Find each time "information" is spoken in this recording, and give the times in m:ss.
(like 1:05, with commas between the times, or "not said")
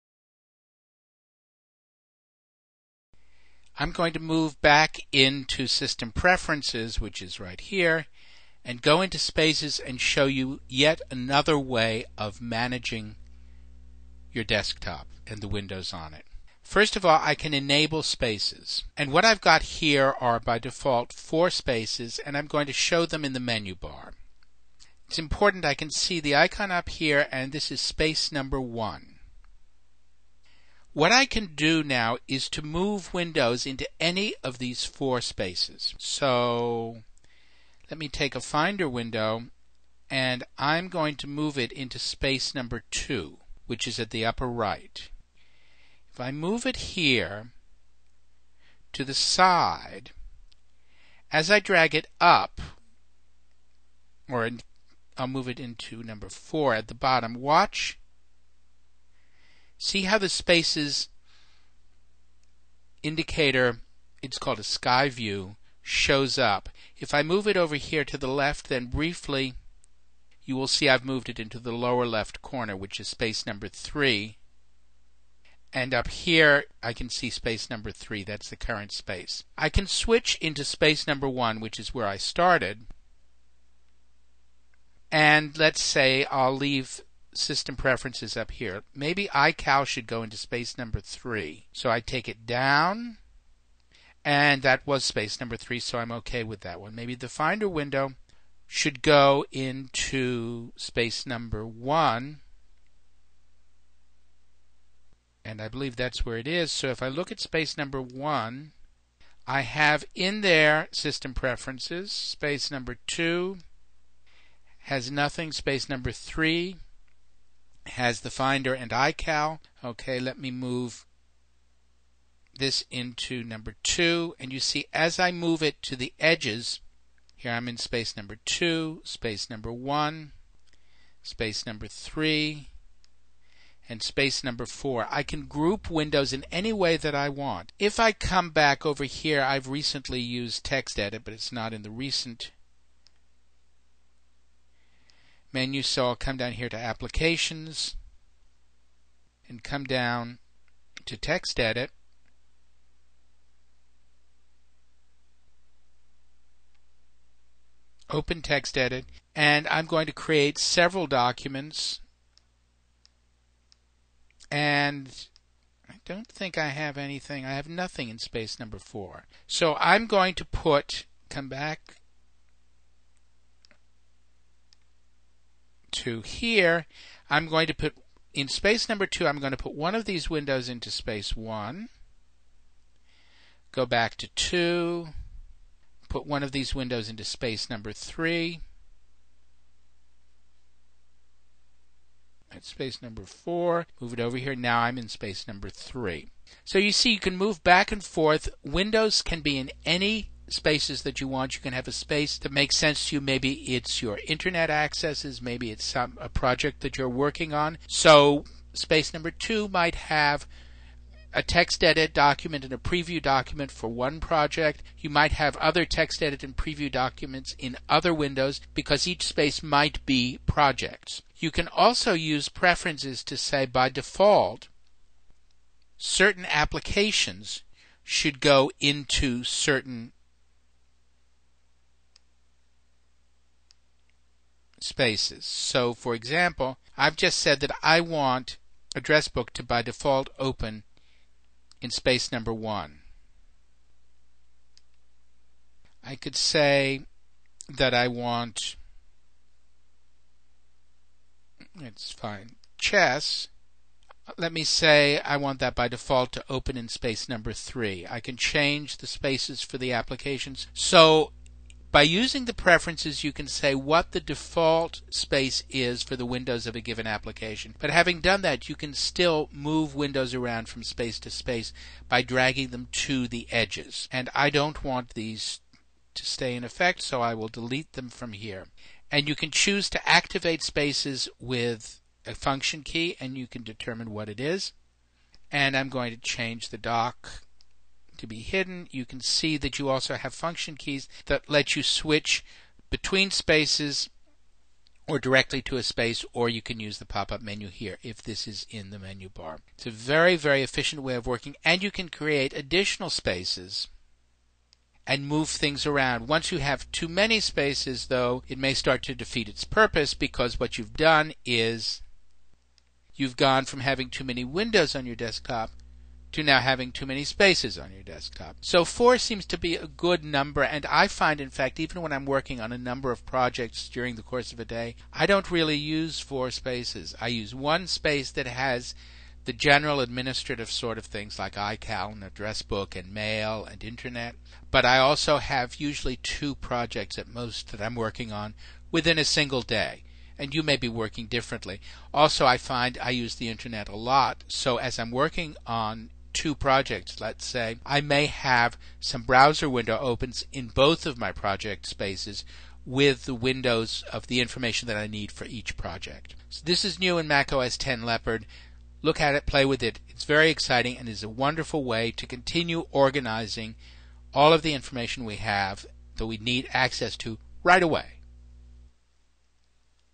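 5:54, 6:04.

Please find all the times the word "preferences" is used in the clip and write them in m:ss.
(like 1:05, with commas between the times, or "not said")
0:06, 1:27, 1:51, 3:42, 4:22.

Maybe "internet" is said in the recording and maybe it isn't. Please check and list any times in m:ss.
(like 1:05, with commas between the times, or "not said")
3:24, 5:33, 5:43.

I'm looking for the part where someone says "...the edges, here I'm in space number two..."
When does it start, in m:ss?
2:05.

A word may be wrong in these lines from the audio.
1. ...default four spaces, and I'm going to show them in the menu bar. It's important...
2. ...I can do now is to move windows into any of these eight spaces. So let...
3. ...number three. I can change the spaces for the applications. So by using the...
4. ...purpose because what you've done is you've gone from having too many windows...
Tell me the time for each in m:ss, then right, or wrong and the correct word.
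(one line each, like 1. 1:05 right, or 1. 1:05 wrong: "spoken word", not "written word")
1. 0:20 right
2. 0:31 wrong: "four", not "eight"
3. 4:17 right
4. 5:09 right.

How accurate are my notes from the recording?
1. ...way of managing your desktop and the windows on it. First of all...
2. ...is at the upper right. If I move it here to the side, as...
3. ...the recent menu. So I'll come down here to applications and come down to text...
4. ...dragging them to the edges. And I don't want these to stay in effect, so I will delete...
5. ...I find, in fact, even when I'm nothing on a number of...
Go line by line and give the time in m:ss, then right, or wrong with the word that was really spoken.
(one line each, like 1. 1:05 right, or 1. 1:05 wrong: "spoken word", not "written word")
1. 0:11 right
2. 0:43 right
3. 2:21 right
4. 4:32 right
5. 5:20 wrong: "working", not "nothing".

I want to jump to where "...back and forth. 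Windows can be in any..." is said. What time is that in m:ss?
3:17.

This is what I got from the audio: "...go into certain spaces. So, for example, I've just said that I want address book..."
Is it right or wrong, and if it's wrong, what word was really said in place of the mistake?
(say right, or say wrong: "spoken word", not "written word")
right.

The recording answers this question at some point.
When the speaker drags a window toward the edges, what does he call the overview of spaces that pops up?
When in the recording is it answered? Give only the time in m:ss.
1:04.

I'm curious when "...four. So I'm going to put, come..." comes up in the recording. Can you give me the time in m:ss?
2:48.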